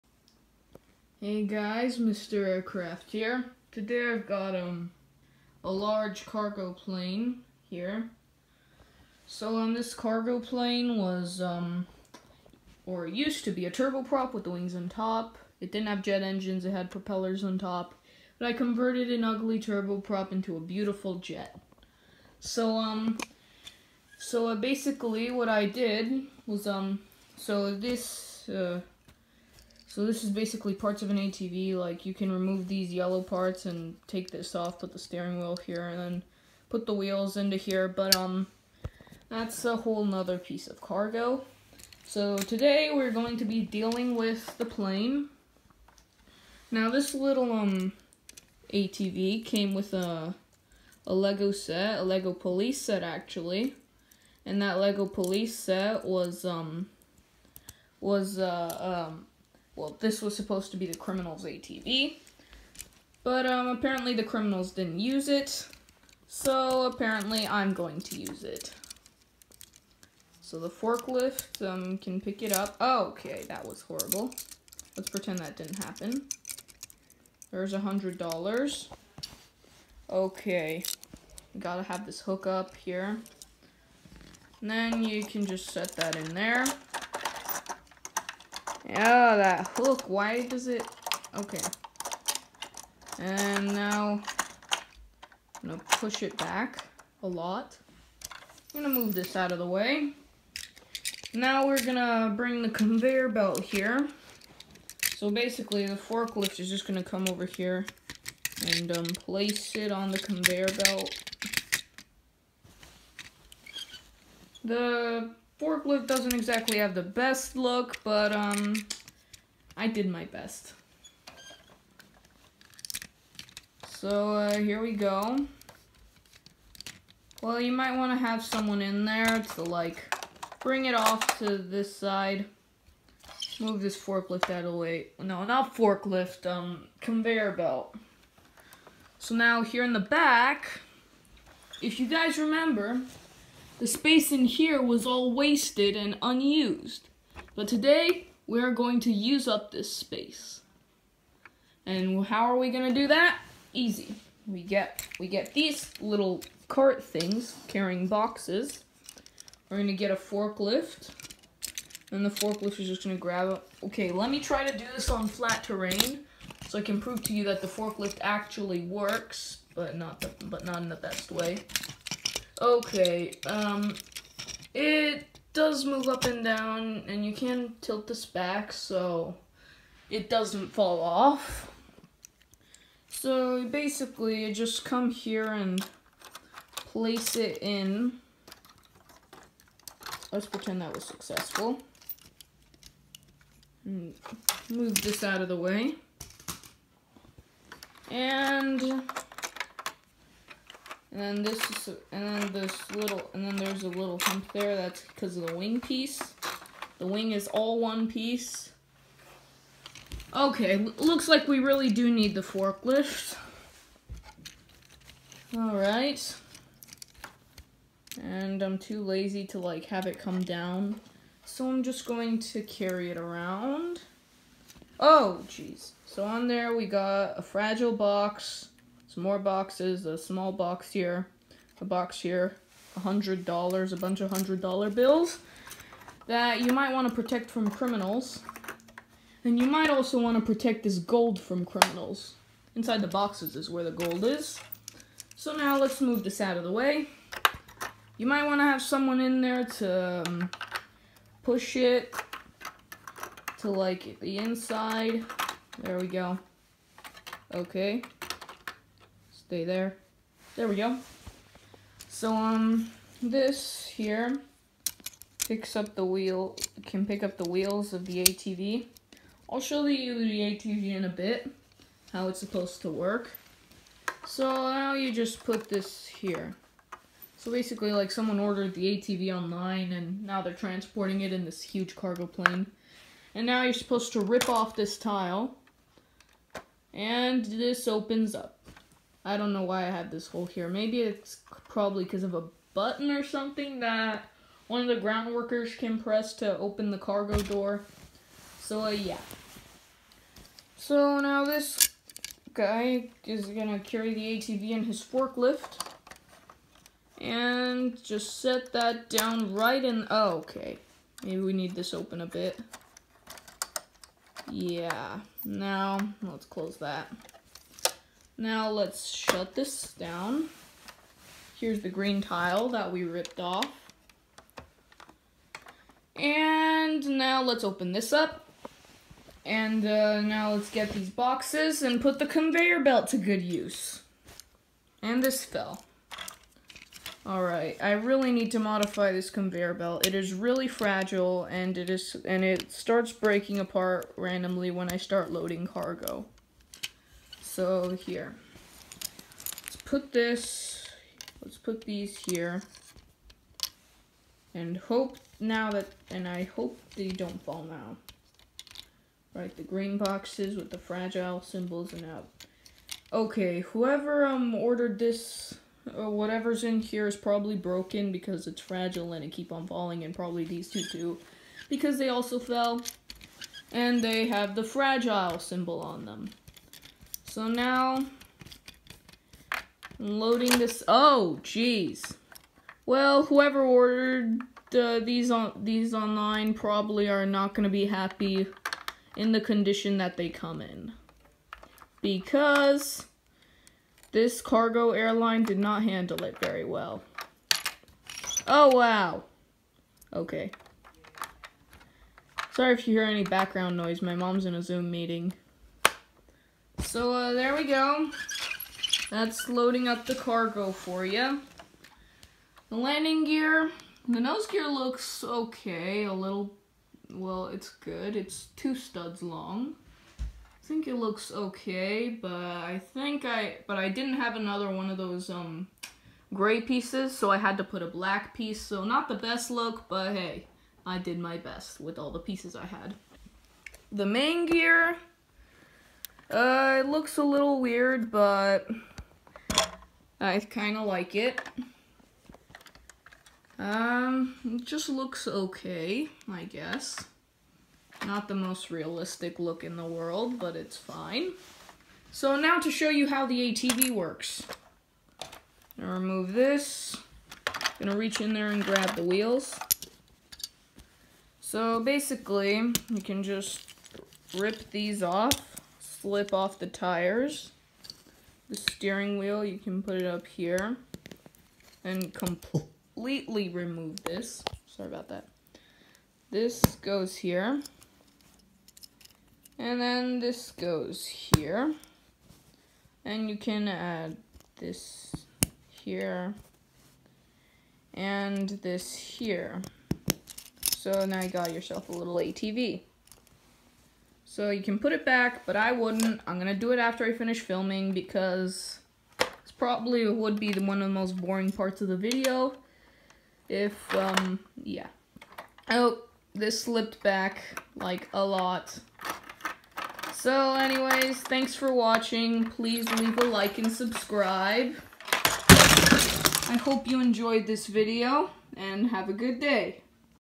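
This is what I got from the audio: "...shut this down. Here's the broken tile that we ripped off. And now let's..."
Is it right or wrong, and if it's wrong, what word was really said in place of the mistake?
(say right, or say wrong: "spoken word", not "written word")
wrong: "green", not "broken".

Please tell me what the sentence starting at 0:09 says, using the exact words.
So on um, this cargo plane was um or used to be a turboprop with the wings on top.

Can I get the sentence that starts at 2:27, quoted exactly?
But today, we are going to use up this space.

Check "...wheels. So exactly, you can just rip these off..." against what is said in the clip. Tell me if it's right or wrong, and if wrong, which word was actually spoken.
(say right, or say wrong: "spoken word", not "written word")
wrong: "basically", not "exactly".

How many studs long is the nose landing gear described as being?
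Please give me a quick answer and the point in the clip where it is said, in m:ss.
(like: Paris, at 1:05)
2, at 6:58.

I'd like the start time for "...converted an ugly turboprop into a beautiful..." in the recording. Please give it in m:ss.
0:18.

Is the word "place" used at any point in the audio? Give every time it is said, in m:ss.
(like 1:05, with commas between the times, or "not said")
1:49, 3:06.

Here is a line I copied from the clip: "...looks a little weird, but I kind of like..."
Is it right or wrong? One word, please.
right.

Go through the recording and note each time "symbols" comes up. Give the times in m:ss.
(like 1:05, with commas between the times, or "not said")
6:01, 6:15.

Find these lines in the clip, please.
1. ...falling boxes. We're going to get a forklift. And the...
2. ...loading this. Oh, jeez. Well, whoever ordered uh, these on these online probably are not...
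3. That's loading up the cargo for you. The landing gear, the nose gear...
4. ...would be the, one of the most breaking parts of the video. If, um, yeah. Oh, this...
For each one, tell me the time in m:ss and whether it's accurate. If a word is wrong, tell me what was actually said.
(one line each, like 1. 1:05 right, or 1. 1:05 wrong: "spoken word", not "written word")
1. 2:37 wrong: "carrying", not "falling"
2. 6:20 right
3. 6:49 right
4. 8:20 wrong: "boring", not "breaking".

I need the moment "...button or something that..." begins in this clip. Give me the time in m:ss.
4:52.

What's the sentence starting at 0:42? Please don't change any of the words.
So today we're going to be dealing with the plane.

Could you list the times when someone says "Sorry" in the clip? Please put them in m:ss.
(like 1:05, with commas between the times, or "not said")
6:42, 7:54.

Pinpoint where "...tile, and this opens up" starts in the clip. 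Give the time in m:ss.
4:44.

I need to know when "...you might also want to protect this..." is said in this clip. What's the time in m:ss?
3:59.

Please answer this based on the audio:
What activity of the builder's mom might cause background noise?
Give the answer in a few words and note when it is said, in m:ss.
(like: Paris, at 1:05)
a Zoom meeting, at 6:44.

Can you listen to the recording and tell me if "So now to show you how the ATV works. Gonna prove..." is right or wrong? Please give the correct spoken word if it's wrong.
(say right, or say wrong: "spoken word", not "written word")
wrong: "remove", not "prove".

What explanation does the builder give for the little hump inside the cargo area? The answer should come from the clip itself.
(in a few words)
the wing piece.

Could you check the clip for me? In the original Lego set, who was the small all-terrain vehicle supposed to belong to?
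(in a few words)
the criminals.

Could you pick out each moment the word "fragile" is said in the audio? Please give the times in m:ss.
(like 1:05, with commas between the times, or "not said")
3:47, 5:40, 6:00, 6:08, 6:14.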